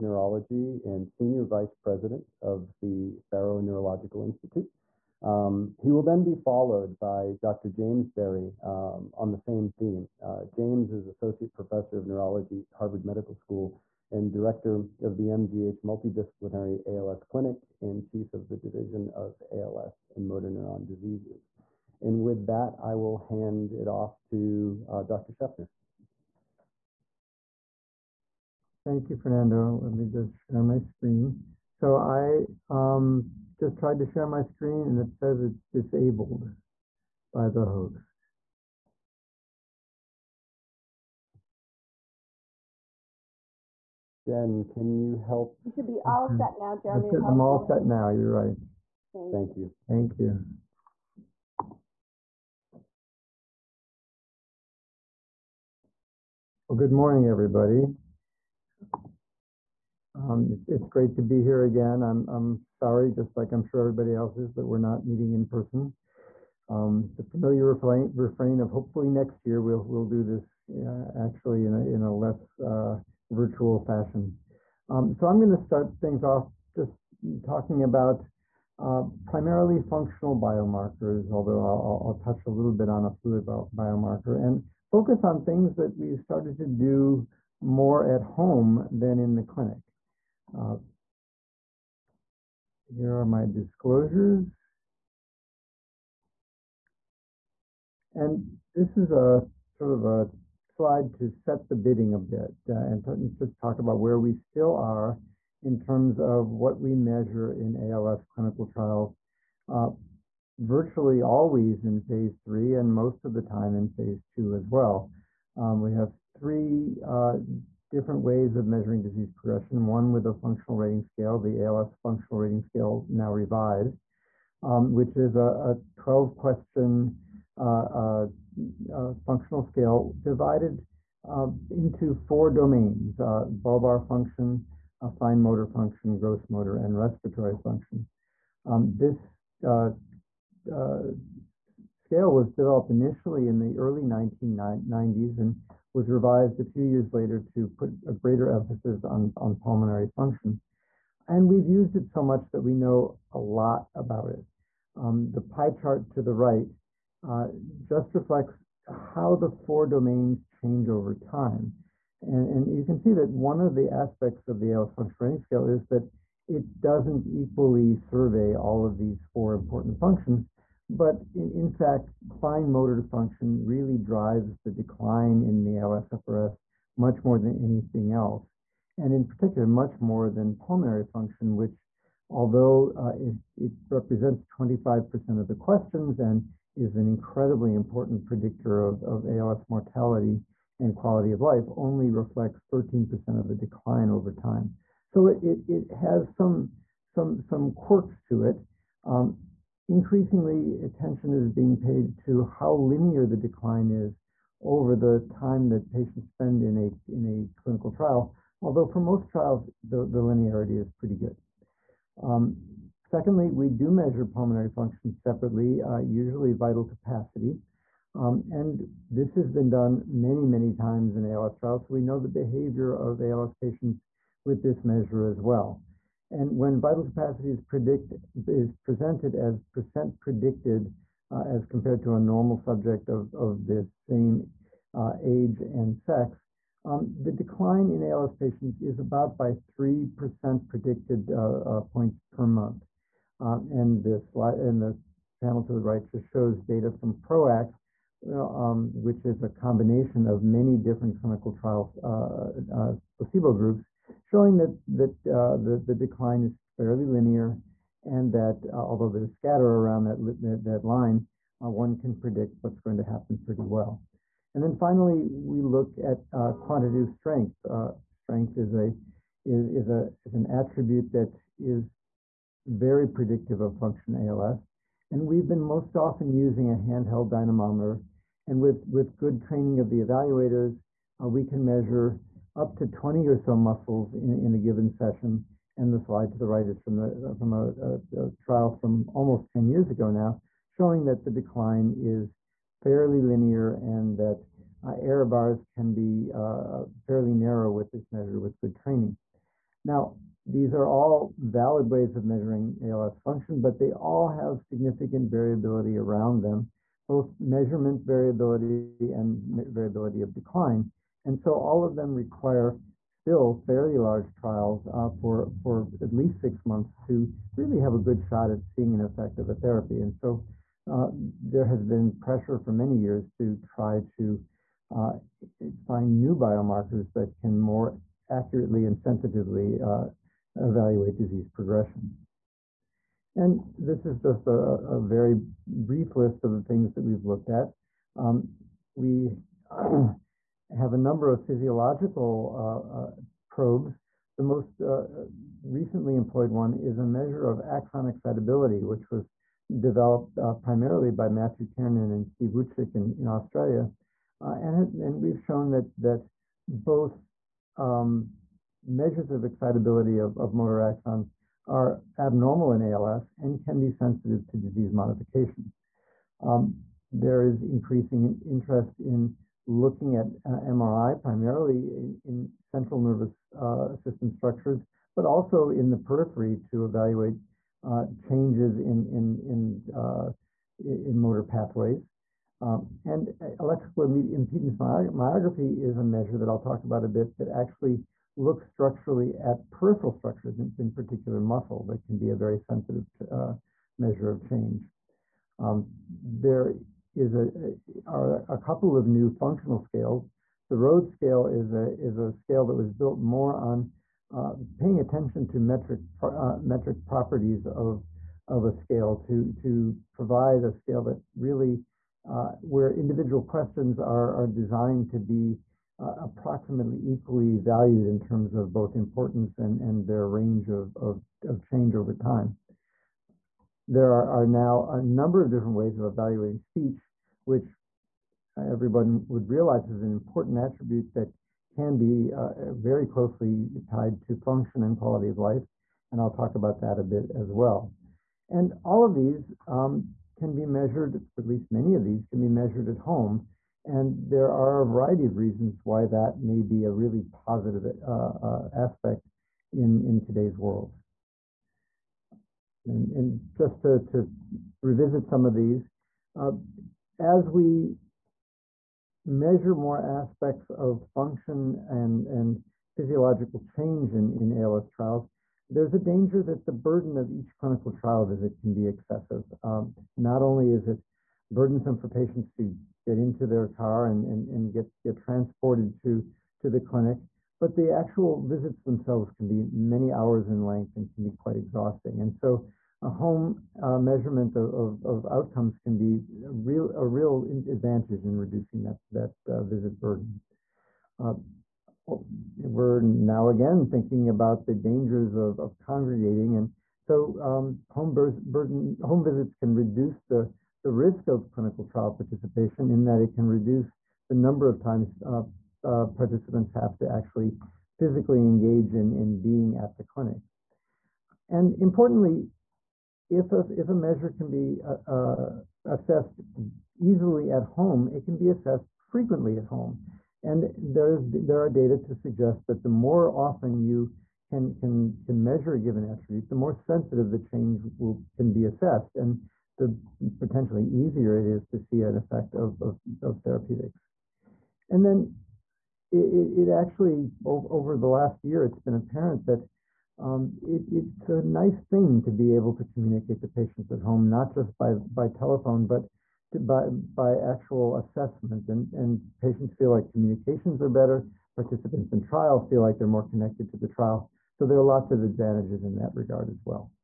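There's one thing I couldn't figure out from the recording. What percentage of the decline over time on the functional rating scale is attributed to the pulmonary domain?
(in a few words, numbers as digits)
13%.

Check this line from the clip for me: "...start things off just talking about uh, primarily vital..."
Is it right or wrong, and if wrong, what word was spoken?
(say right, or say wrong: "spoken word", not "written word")
wrong: "functional", not "vital".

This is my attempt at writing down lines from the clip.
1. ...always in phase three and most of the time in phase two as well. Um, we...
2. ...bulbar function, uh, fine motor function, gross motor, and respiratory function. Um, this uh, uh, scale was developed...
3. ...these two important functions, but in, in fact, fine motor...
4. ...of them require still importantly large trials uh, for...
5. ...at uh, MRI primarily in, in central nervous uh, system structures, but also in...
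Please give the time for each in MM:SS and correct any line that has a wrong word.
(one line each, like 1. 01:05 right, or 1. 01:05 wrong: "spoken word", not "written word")
1. 01:51 right
2. 02:13 right
3. 02:48 wrong: "four", not "two"
4. 05:11 wrong: "fairly", not "importantly"
5. 06:10 right.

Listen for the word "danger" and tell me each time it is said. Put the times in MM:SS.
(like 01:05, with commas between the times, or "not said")
07:45, 08:14.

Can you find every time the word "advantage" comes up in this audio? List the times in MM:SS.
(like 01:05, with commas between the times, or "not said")
08:07, 09:15.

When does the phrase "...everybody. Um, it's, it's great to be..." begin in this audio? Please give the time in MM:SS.
00:57.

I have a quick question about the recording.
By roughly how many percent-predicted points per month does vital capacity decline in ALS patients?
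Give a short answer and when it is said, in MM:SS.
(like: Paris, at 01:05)
3, at 03:59.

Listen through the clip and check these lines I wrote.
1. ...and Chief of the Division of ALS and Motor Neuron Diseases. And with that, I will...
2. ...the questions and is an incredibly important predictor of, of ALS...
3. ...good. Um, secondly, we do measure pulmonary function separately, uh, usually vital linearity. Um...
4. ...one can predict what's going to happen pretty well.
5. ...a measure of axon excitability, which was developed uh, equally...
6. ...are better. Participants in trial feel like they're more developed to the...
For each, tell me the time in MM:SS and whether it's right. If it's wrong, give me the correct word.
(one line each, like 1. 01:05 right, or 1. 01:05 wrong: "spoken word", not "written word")
1. 00:17 right
2. 03:05 right
3. 03:31 wrong: "capacity", not "linearity"
4. 04:21 right
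5. 05:46 wrong: "primarily", not "equally"
6. 09:10 wrong: "connected", not "developed".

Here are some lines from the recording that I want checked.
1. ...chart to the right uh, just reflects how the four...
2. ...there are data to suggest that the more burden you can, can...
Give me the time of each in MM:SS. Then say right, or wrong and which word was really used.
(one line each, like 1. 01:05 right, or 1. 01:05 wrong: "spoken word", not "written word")
1. 02:35 right
2. 08:41 wrong: "often", not "burden".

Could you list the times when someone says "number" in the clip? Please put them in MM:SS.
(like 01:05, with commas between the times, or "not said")
05:40, 07:05, 08:24.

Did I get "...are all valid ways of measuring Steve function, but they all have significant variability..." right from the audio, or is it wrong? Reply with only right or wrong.
wrong.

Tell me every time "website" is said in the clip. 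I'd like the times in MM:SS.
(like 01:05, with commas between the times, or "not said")
not said.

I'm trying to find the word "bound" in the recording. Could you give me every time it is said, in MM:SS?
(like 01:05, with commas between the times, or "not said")
not said.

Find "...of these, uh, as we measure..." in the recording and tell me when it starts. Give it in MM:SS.
07:35.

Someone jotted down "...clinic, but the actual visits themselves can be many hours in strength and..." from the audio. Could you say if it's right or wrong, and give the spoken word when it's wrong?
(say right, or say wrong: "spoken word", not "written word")
wrong: "length", not "strength".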